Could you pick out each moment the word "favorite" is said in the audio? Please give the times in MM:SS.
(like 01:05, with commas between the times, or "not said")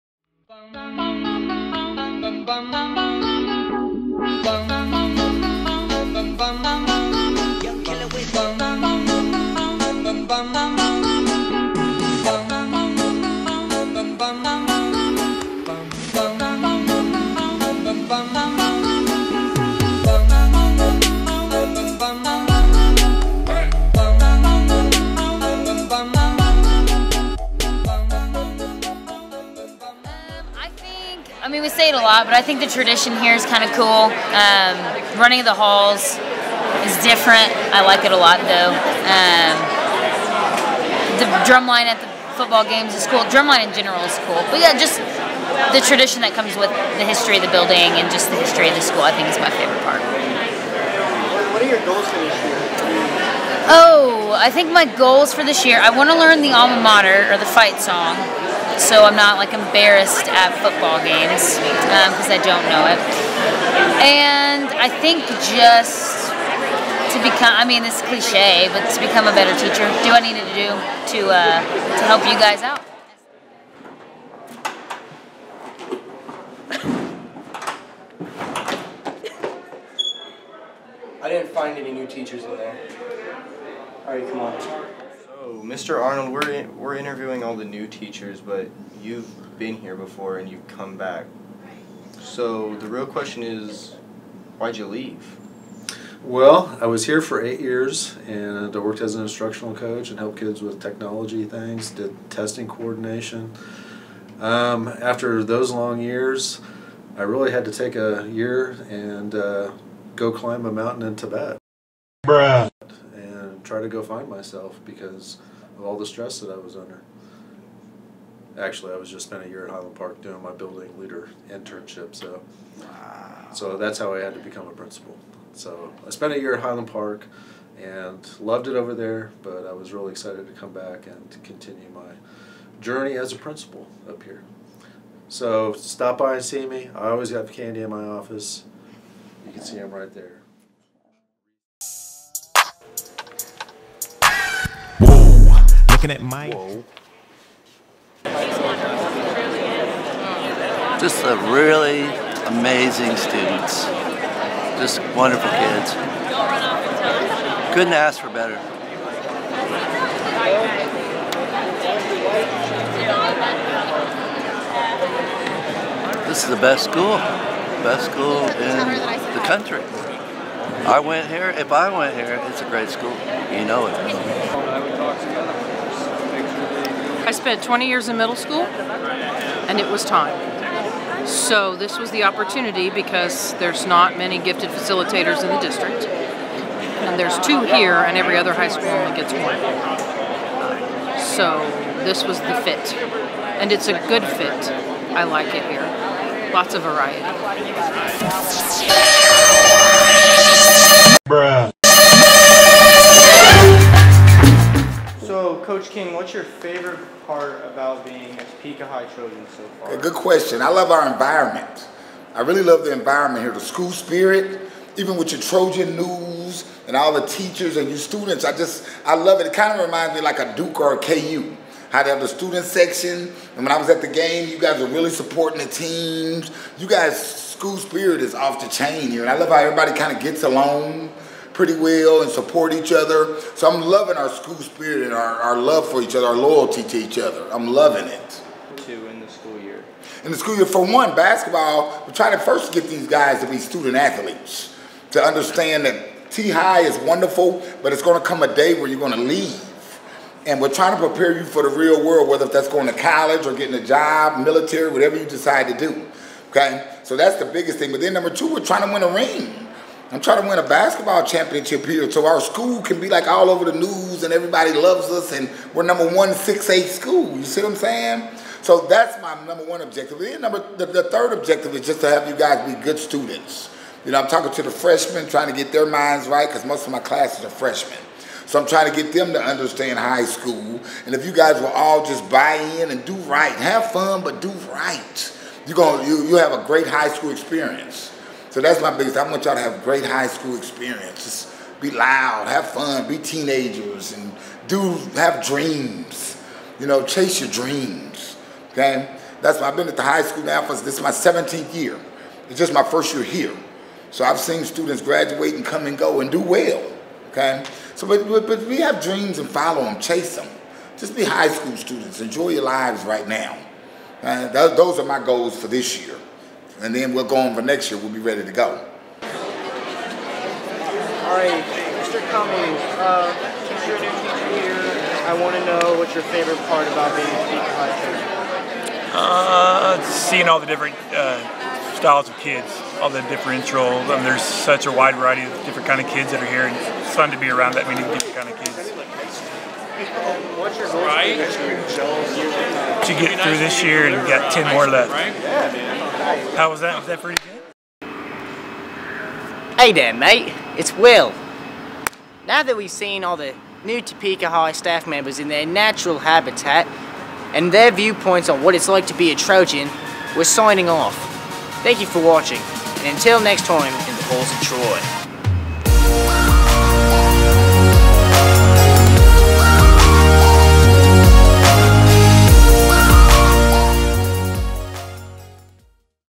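00:49, 03:26, 05:26.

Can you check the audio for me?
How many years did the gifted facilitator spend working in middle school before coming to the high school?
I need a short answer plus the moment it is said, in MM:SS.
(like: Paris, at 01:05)
20, at 02:57.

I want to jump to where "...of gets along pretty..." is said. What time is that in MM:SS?
03:50.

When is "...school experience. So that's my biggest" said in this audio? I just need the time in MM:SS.
04:47.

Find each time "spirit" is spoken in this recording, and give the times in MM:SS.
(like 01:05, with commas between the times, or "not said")
03:33, 03:47, 03:54.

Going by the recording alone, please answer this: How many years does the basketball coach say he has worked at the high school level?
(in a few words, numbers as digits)
17.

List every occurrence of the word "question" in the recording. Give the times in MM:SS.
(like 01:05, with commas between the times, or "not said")
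01:33, 03:30.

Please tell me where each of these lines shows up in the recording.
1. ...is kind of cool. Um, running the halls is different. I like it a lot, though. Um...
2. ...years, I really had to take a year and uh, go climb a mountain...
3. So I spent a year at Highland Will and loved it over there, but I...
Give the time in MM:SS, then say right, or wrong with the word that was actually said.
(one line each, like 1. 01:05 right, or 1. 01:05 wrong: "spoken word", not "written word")
1. 00:33 right
2. 01:46 right
3. 02:05 wrong: "Park", not "Will".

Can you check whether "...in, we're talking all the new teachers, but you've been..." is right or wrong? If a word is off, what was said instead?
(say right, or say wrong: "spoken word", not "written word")
wrong: "interviewing", not "talking".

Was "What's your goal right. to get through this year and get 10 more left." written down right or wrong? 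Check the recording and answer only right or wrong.
right.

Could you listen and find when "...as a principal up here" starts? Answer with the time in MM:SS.
02:13.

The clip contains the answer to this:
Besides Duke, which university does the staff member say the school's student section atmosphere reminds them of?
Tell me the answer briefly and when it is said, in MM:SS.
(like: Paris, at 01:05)
KU, at 03:40.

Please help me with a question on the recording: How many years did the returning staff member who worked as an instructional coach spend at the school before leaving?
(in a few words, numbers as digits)
8.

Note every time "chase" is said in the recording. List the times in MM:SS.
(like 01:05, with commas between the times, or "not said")
04:57, 05:10.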